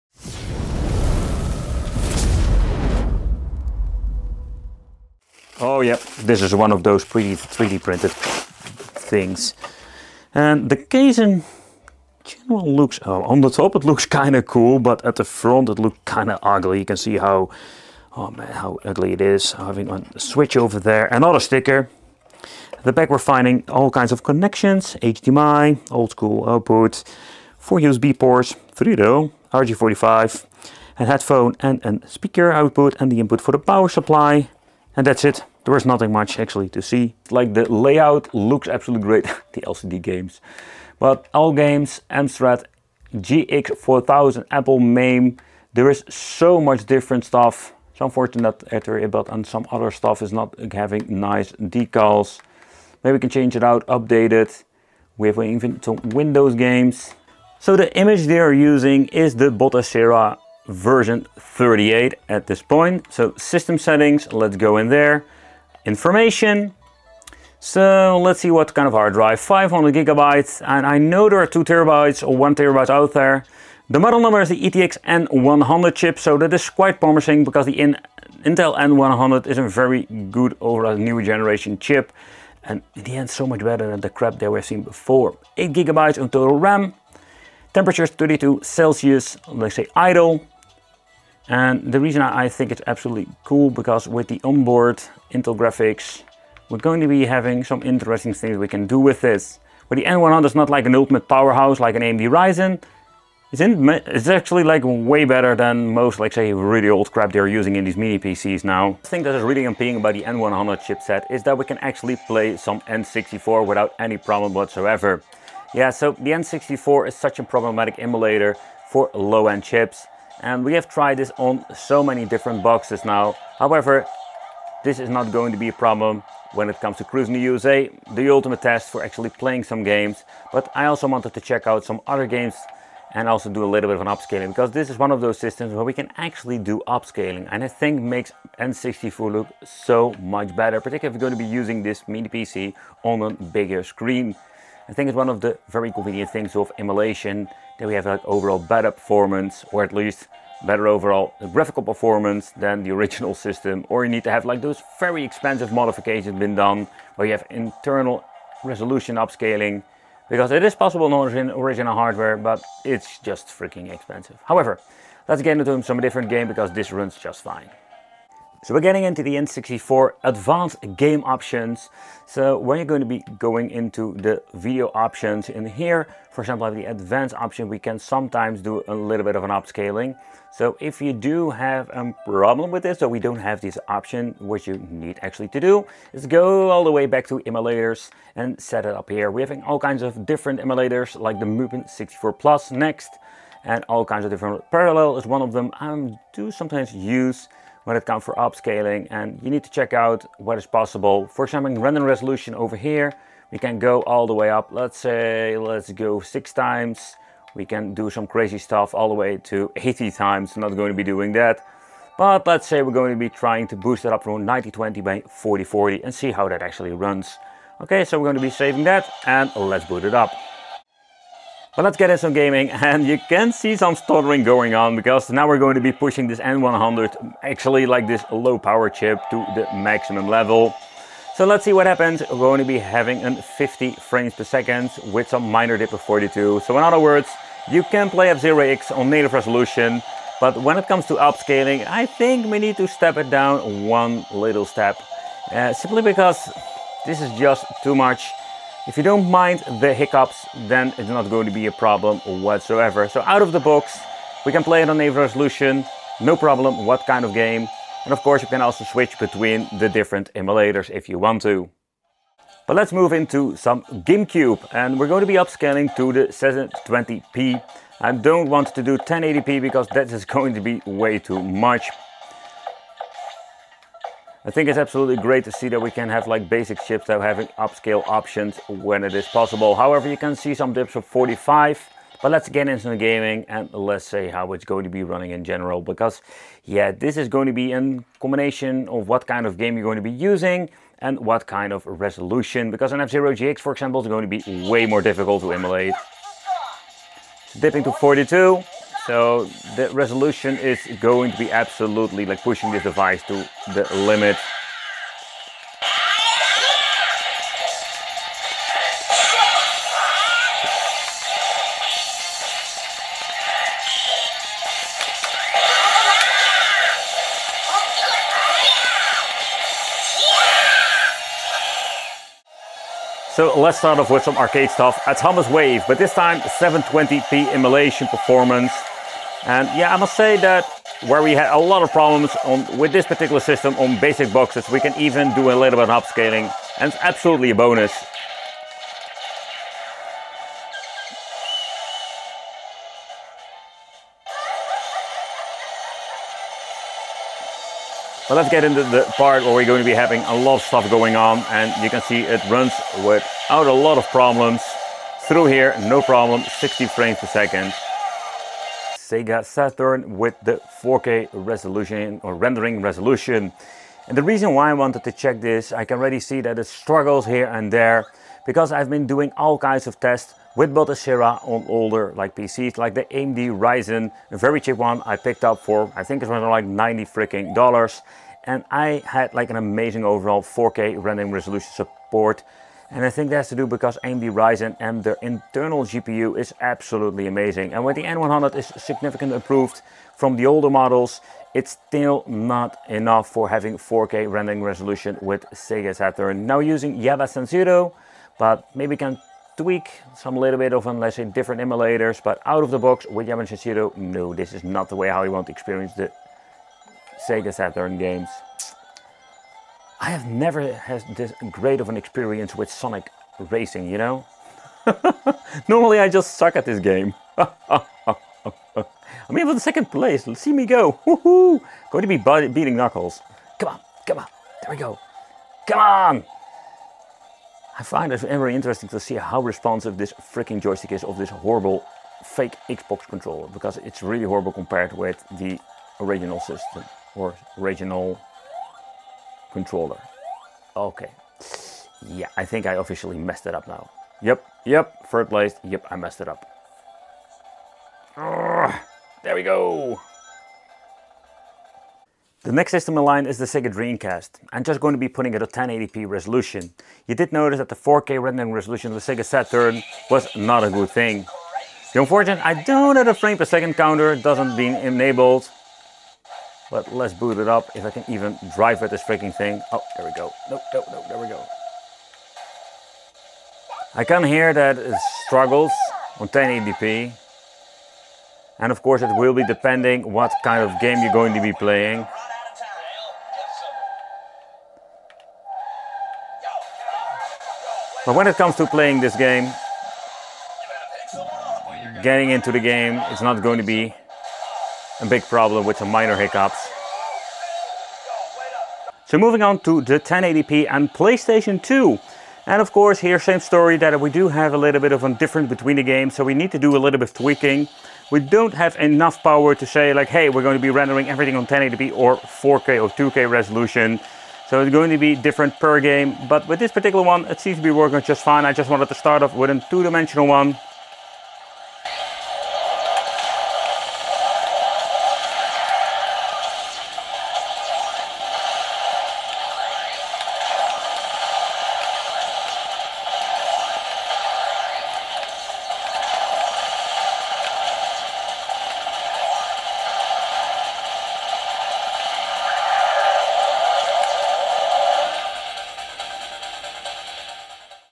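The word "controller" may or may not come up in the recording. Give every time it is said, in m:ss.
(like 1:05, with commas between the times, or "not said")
7:13, 7:19.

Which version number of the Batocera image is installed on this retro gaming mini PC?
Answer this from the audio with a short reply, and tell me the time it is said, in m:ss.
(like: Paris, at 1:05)
38, at 1:00.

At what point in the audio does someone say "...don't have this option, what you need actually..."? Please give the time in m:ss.
3:03.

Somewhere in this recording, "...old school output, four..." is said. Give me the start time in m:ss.
0:25.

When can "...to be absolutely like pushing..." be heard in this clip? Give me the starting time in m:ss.
5:01.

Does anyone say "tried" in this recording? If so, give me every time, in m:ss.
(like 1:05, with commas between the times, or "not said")
2:00.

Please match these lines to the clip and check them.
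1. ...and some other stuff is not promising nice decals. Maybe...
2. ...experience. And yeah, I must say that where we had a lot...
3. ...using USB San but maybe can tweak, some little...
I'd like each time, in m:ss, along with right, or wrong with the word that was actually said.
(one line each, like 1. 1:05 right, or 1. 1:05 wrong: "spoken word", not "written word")
1. 0:49 wrong: "having", not "promising"
2. 5:28 wrong: "performance", not "experience"
3. 6:36 wrong: "Java", not "USB".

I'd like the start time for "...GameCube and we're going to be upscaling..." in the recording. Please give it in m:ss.
4:23.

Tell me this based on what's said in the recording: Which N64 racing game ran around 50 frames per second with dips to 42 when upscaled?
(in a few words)
F-Zero X.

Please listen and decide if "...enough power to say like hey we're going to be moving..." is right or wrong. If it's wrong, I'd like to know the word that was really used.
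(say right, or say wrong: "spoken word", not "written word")
wrong: "rendering", not "moving".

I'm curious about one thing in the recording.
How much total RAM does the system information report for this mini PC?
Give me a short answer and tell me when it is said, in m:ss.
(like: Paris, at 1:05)
8 gigabytes, at 1:25.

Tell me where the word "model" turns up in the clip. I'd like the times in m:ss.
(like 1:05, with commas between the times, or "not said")
1:13, 6:30.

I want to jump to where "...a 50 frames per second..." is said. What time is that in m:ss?
3:53.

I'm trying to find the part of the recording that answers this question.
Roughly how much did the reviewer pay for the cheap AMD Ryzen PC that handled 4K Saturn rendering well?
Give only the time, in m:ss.
6:16.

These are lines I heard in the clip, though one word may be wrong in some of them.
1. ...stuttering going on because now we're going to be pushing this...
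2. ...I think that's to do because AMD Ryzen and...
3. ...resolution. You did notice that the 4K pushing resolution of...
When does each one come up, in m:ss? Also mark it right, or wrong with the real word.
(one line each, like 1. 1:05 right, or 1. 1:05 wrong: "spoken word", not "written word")
1. 3:43 right
2. 6:23 right
3. 7:36 wrong: "rendering", not "pushing".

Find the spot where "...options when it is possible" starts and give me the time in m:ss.
4:38.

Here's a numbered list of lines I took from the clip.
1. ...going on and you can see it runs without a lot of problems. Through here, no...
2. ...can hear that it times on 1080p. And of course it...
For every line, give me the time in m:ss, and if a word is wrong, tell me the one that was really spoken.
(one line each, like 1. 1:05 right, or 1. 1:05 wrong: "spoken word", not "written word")
1. 5:50 right
2. 7:54 wrong: "struggles", not "times".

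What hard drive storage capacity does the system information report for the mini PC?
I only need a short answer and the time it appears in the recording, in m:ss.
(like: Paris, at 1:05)
500 gigabytes, at 1:09.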